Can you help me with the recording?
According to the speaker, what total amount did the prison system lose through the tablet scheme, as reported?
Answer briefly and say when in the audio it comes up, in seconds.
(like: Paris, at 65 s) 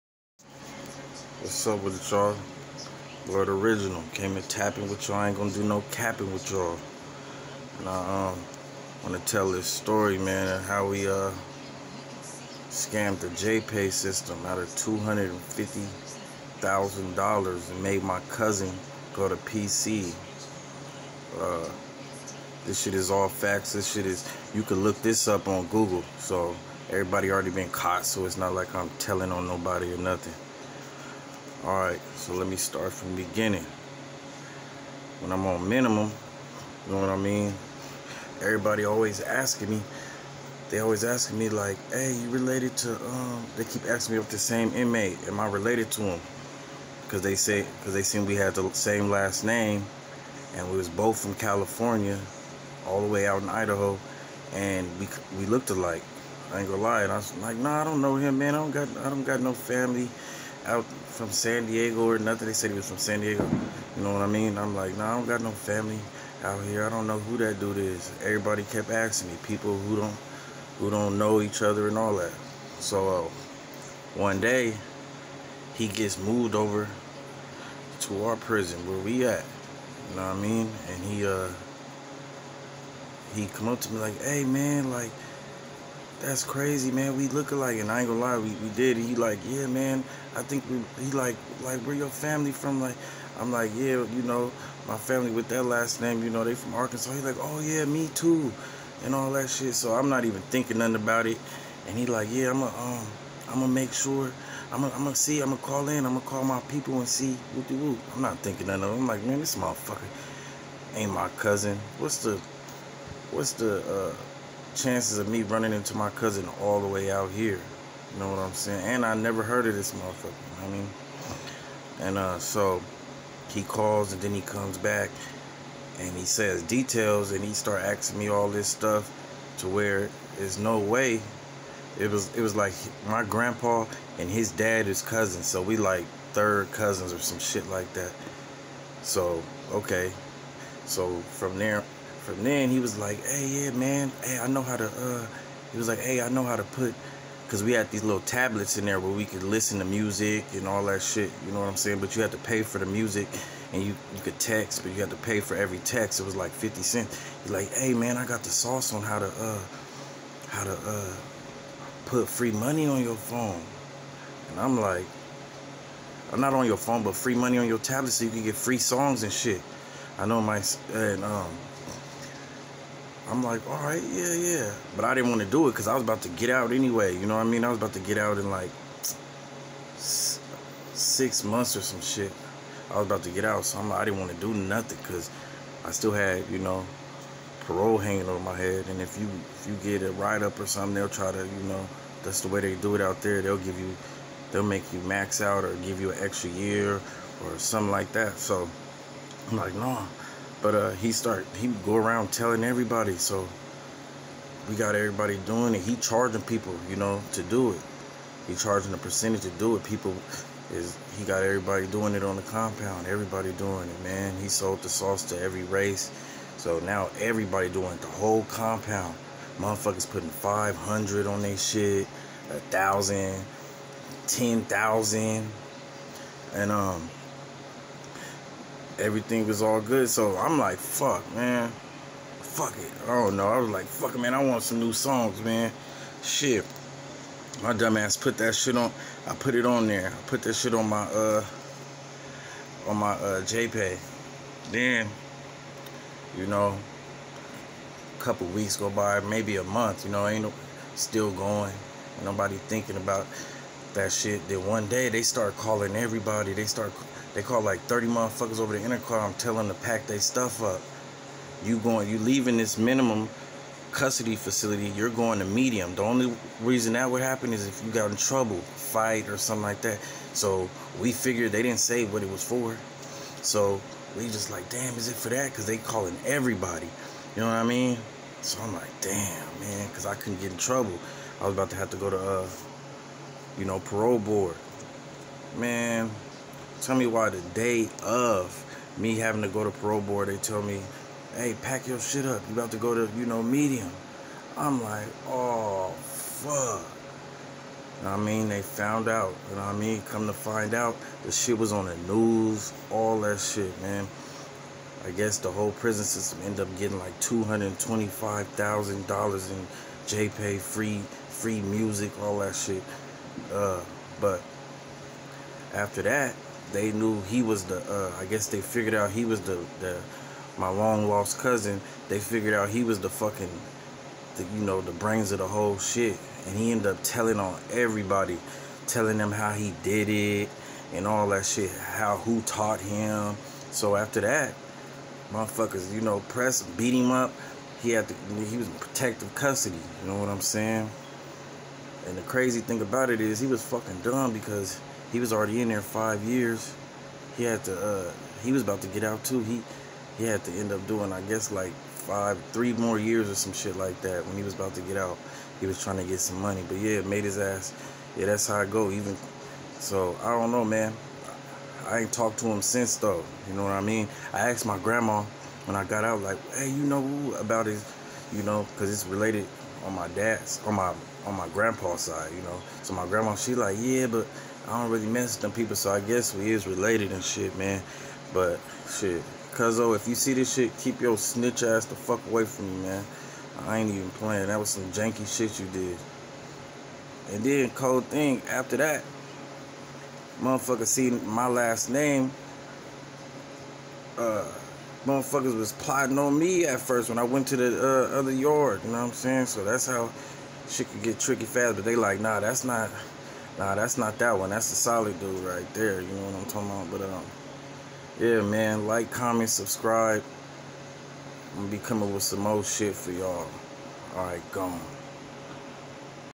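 $225,000, at 307 s.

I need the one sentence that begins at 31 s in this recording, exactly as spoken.
Alright, so let me start from the beginning.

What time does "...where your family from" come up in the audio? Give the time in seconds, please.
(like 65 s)
91 s.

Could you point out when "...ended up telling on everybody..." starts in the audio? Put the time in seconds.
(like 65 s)
326 s.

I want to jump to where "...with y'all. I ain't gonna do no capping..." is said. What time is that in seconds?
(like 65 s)
4 s.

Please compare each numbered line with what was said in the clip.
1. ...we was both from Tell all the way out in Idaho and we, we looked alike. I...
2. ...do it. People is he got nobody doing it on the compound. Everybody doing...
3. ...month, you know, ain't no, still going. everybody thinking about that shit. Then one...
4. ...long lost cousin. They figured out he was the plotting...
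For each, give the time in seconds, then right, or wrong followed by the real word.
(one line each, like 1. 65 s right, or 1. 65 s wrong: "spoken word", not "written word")
1. 50 s wrong: "California", not "Tell"
2. 209 s wrong: "everybody", not "nobody"
3. 249 s wrong: "nobody", not "everybody"
4. 320 s wrong: "fucking", not "plotting".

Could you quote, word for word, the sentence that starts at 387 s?
And then cold thing after that, motherfucker seen my last name.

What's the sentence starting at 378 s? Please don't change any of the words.
But shit, Cuzzo, if you see this shit, keep your snitch ass the fuck away from me, man.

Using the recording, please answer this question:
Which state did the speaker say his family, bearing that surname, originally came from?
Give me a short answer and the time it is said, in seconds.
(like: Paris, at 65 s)
Arkansas, at 96 s.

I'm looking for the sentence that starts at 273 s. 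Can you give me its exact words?
So we just like, damn, is it for that?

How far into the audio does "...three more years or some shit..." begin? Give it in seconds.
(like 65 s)
352 s.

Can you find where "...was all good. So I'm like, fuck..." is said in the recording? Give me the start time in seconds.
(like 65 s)
229 s.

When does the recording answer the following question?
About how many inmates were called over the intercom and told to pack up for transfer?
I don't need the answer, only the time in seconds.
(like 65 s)
257 s.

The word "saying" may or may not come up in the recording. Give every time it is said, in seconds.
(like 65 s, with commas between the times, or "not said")
118 s, 151 s, 340 s, 399 s.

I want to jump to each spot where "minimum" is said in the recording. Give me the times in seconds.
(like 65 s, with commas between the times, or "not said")
35 s, 262 s.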